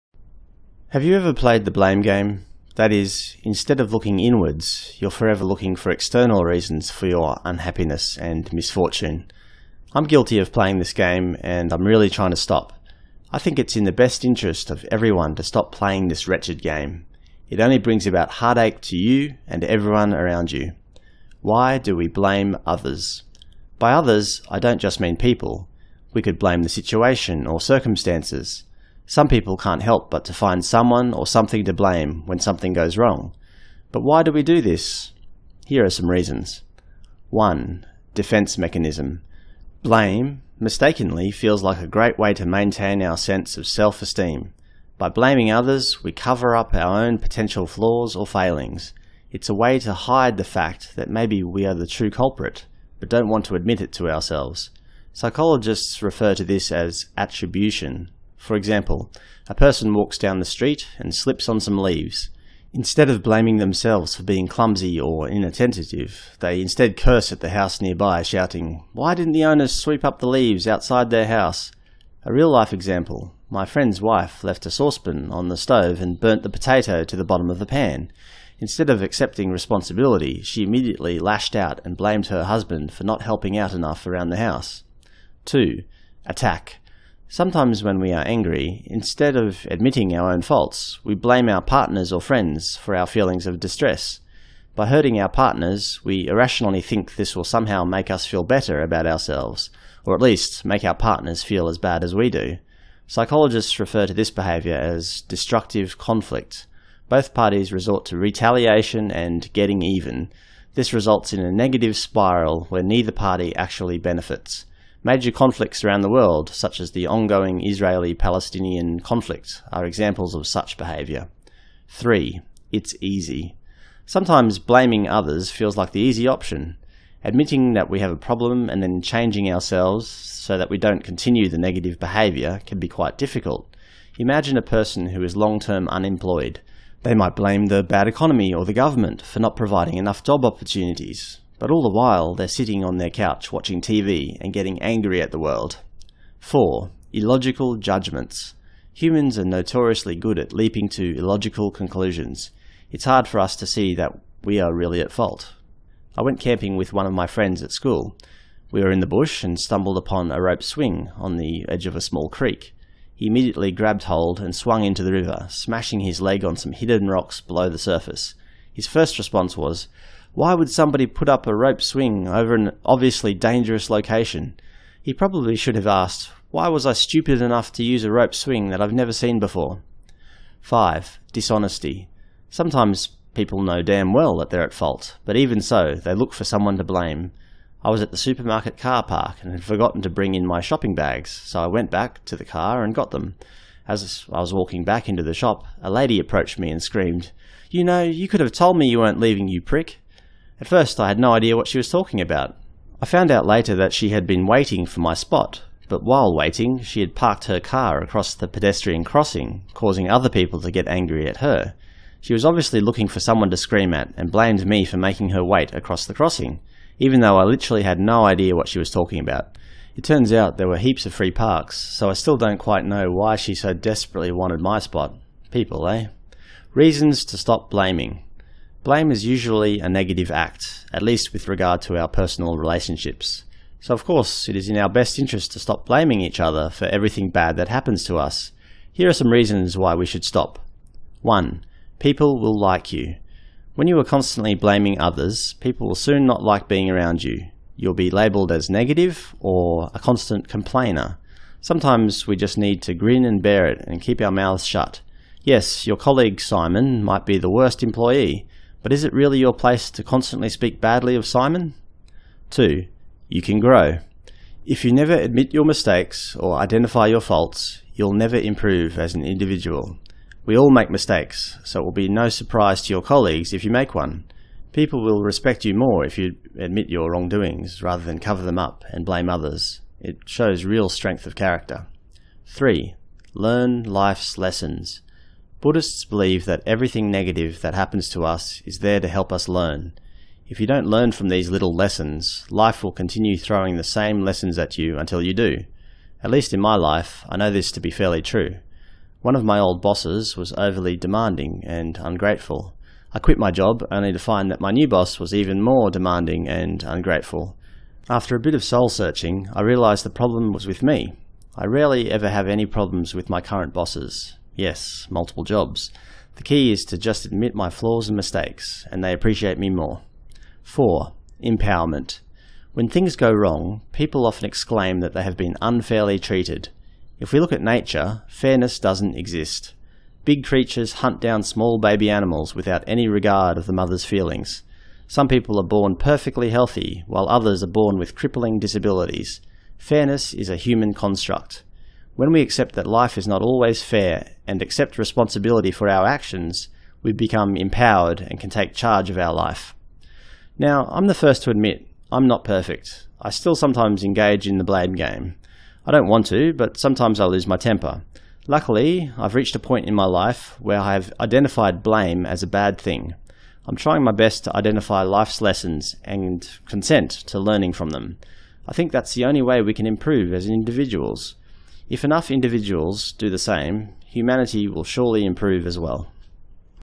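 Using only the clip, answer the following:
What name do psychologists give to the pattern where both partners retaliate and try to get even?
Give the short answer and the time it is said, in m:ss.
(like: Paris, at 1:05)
destructive conflict, at 1:45.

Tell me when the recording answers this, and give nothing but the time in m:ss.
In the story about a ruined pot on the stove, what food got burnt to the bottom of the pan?
1:16.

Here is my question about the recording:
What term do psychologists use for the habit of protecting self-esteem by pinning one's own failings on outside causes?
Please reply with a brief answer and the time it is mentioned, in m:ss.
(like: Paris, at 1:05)
attribution, at 0:57.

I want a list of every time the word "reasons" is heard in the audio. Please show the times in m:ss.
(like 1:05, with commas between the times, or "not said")
0:06, 0:36, 3:46, 3:59.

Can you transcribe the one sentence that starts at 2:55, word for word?
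He probably should have asked, why was I stupid enough to use a rope swing that I've never seen before?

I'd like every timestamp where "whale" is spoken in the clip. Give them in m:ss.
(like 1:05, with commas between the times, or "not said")
not said.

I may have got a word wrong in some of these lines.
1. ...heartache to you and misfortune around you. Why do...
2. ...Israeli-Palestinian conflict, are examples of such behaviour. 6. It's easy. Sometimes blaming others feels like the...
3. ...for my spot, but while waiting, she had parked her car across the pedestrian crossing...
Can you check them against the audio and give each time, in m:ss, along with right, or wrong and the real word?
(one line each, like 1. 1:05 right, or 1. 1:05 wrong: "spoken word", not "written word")
1. 0:18 wrong: "everyone", not "misfortune"
2. 1:57 wrong: "3", not "6"
3. 3:24 right.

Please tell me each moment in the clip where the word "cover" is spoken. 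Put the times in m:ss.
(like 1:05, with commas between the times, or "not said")
0:46, 4:38.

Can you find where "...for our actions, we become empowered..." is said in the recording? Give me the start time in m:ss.
5:45.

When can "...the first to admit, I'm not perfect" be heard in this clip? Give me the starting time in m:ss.
5:51.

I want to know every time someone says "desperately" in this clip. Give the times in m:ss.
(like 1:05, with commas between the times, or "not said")
3:43.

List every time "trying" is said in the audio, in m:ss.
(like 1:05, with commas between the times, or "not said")
0:12, 6:03.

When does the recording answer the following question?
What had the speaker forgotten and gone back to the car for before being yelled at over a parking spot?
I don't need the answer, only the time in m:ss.
3:10.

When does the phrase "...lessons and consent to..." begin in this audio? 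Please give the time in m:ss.
6:05.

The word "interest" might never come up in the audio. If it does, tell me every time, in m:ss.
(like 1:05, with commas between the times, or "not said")
0:14, 3:55.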